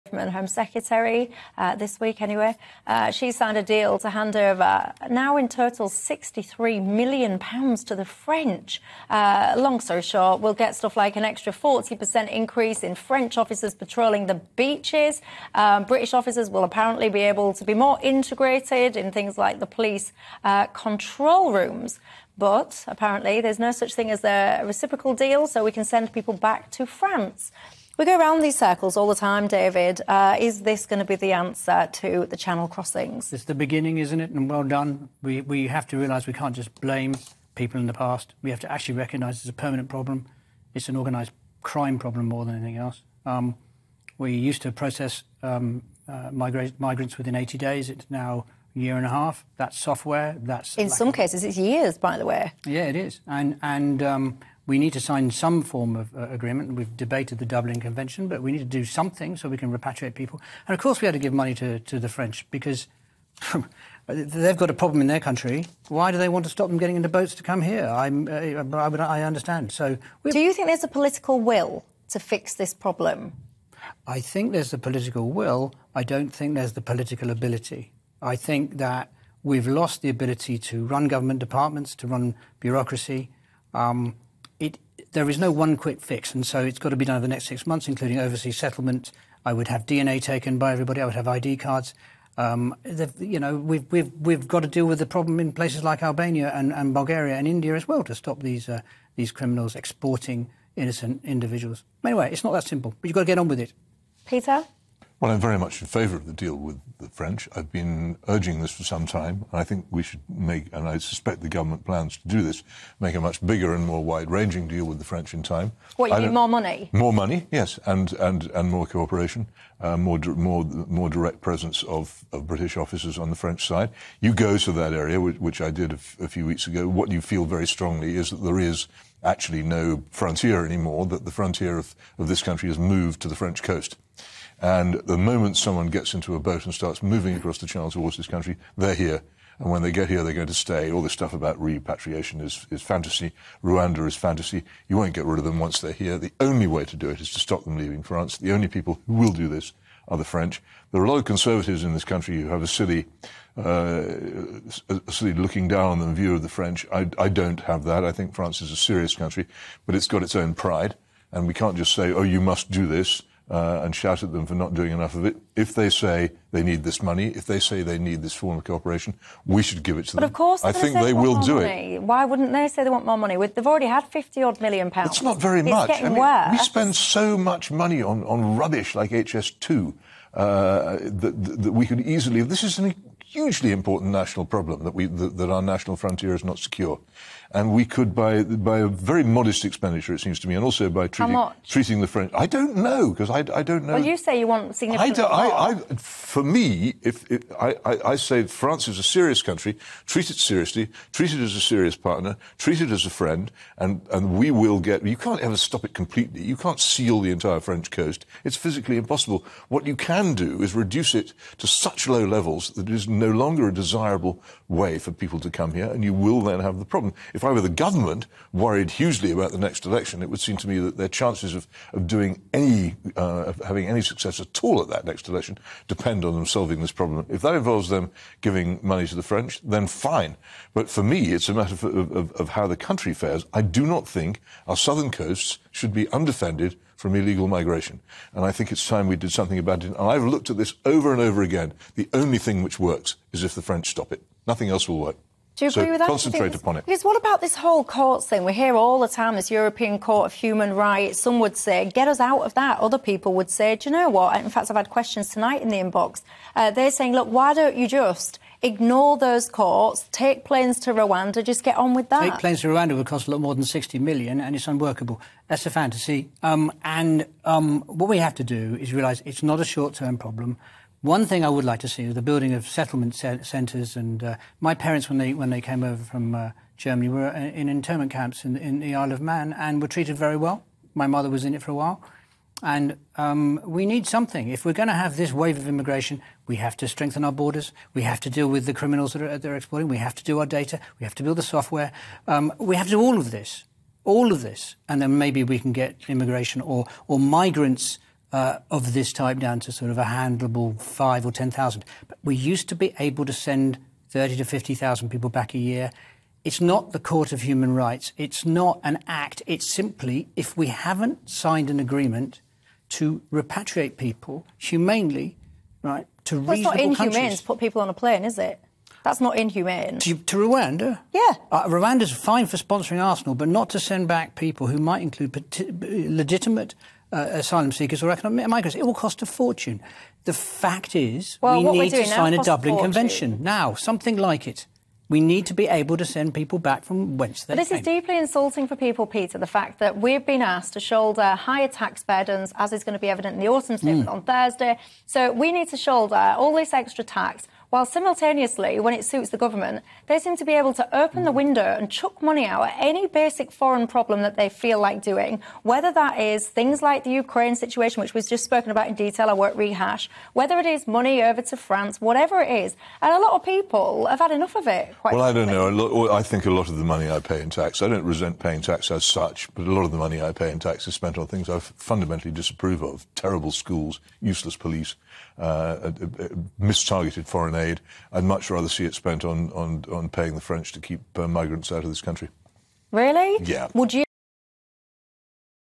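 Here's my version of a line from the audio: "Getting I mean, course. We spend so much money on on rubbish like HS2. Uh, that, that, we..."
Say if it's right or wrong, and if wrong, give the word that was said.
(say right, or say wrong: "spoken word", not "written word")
wrong: "worse", not "course".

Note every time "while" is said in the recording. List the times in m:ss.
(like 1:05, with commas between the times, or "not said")
4:41, 5:47.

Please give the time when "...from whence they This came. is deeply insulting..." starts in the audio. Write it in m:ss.
5:36.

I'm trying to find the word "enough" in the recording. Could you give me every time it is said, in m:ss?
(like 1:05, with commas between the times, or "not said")
2:44, 6:04.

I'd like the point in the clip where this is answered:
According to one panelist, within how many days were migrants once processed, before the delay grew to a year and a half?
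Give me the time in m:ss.
0:47.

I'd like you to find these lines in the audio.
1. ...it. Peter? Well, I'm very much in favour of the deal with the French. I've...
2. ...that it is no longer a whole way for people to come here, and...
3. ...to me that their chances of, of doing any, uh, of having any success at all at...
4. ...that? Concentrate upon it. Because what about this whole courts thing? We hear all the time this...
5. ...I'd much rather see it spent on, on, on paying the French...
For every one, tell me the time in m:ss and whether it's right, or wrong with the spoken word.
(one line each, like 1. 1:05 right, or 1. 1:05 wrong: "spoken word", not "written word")
1. 1:43 right
2. 3:32 wrong: "desirable", not "whole"
3. 3:40 right
4. 4:05 right
5. 6:18 right.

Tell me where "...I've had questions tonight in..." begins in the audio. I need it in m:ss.
4:14.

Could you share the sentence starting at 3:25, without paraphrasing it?
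You can't ever stop it completely.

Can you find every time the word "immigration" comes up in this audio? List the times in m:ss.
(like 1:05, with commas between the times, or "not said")
4:45, 4:56.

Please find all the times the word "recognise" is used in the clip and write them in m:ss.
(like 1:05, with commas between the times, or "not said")
0:38.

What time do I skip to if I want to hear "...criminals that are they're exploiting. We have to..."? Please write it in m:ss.
4:48.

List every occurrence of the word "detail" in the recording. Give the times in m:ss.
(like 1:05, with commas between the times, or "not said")
5:58.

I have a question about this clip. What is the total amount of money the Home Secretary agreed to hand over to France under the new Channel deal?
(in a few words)
63 million pounds.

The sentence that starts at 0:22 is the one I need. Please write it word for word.
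But apparently, there's no such thing as a reciprocal deal, so we can send people back to France.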